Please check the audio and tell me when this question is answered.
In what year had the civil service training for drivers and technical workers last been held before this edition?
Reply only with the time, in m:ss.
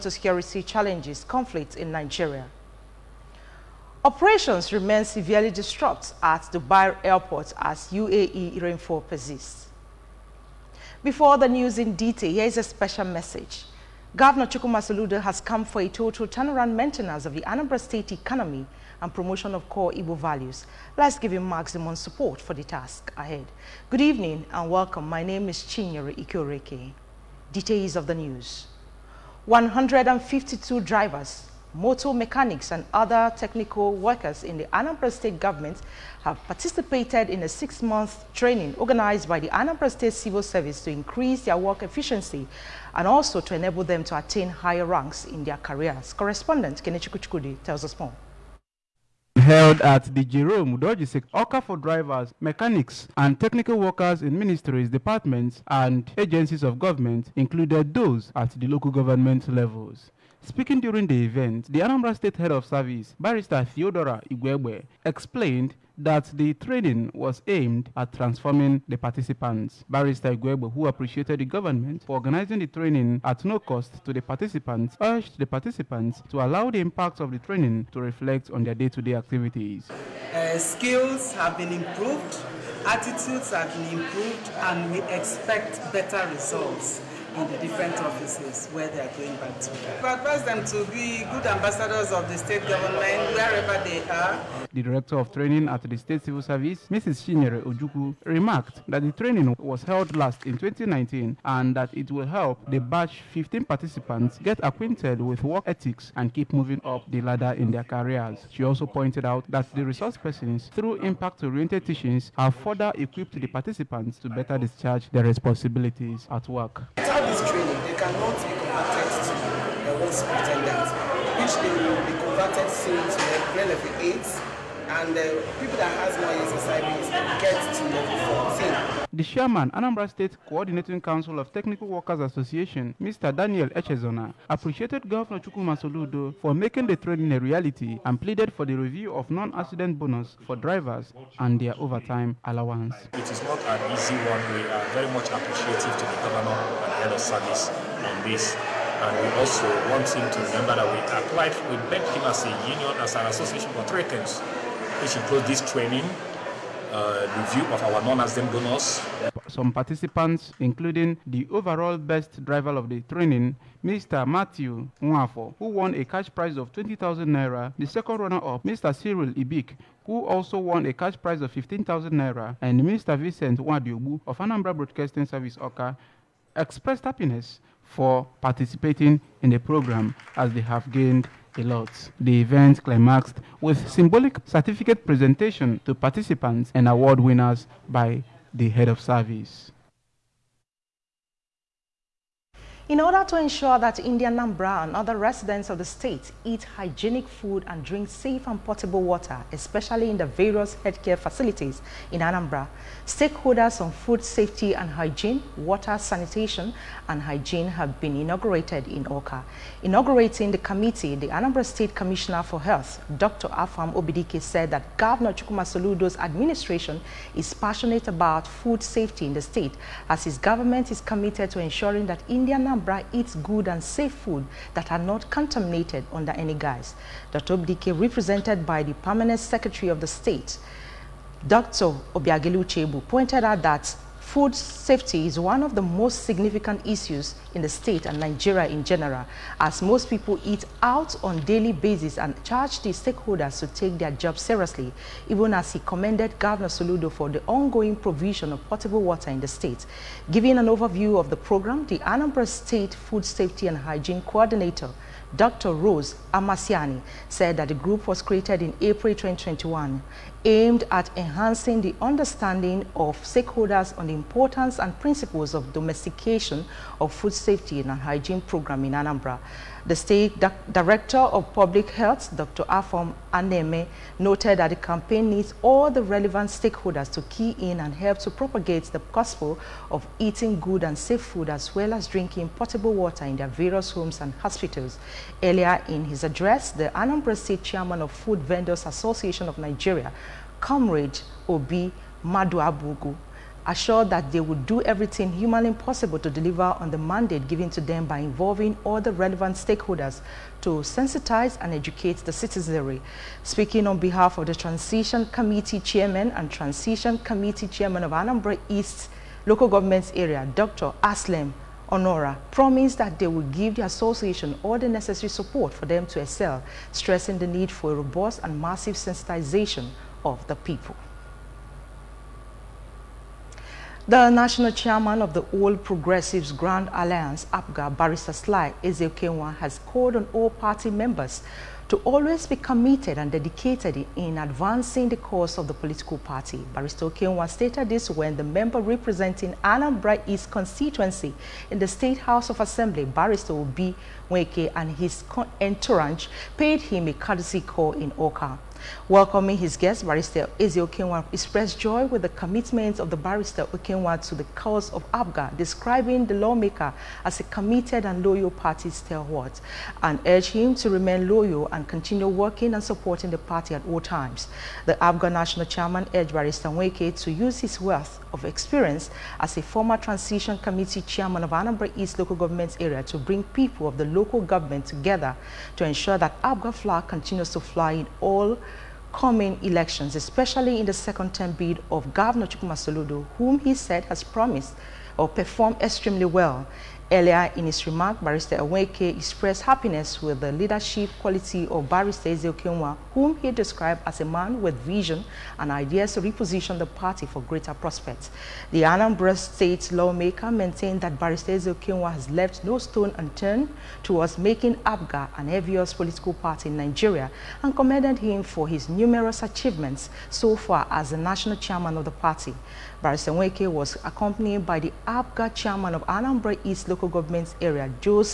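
1:40.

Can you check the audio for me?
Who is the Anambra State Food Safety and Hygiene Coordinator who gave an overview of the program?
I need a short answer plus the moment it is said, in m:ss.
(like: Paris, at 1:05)
Dr. Rose Amasiani, at 4:15.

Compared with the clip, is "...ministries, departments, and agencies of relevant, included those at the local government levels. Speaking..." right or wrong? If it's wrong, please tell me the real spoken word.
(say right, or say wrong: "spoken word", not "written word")
wrong: "government", not "relevant".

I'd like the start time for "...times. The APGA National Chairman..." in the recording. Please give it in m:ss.
6:03.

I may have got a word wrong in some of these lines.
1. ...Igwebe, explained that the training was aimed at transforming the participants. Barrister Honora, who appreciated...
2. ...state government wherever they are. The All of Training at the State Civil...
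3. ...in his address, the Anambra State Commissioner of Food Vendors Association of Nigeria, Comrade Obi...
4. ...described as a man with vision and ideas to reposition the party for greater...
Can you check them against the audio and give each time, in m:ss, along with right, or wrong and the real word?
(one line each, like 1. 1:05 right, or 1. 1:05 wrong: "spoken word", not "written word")
1. 1:04 wrong: "Igwebe", not "Honora"
2. 1:32 wrong: "Director", not "All"
3. 4:45 wrong: "Chairman", not "Commissioner"
4. 6:33 right.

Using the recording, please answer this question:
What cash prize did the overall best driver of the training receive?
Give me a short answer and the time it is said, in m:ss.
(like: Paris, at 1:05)
20,000 naira, at 2:46.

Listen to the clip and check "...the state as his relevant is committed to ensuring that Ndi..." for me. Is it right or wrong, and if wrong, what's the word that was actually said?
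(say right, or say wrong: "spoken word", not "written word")
wrong: "government", not "relevant".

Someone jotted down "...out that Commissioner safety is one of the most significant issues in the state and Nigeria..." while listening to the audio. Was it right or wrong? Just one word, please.
wrong.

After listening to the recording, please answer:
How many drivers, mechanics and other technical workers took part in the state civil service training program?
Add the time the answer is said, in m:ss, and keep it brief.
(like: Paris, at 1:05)
152, at 0:29.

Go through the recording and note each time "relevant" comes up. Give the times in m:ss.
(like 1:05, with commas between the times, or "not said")
4:36, 4:59.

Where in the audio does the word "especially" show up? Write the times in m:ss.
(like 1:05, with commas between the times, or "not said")
3:19, 6:20.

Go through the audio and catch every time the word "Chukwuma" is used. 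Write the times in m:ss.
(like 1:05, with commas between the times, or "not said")
0:14, 2:15, 3:35, 6:22.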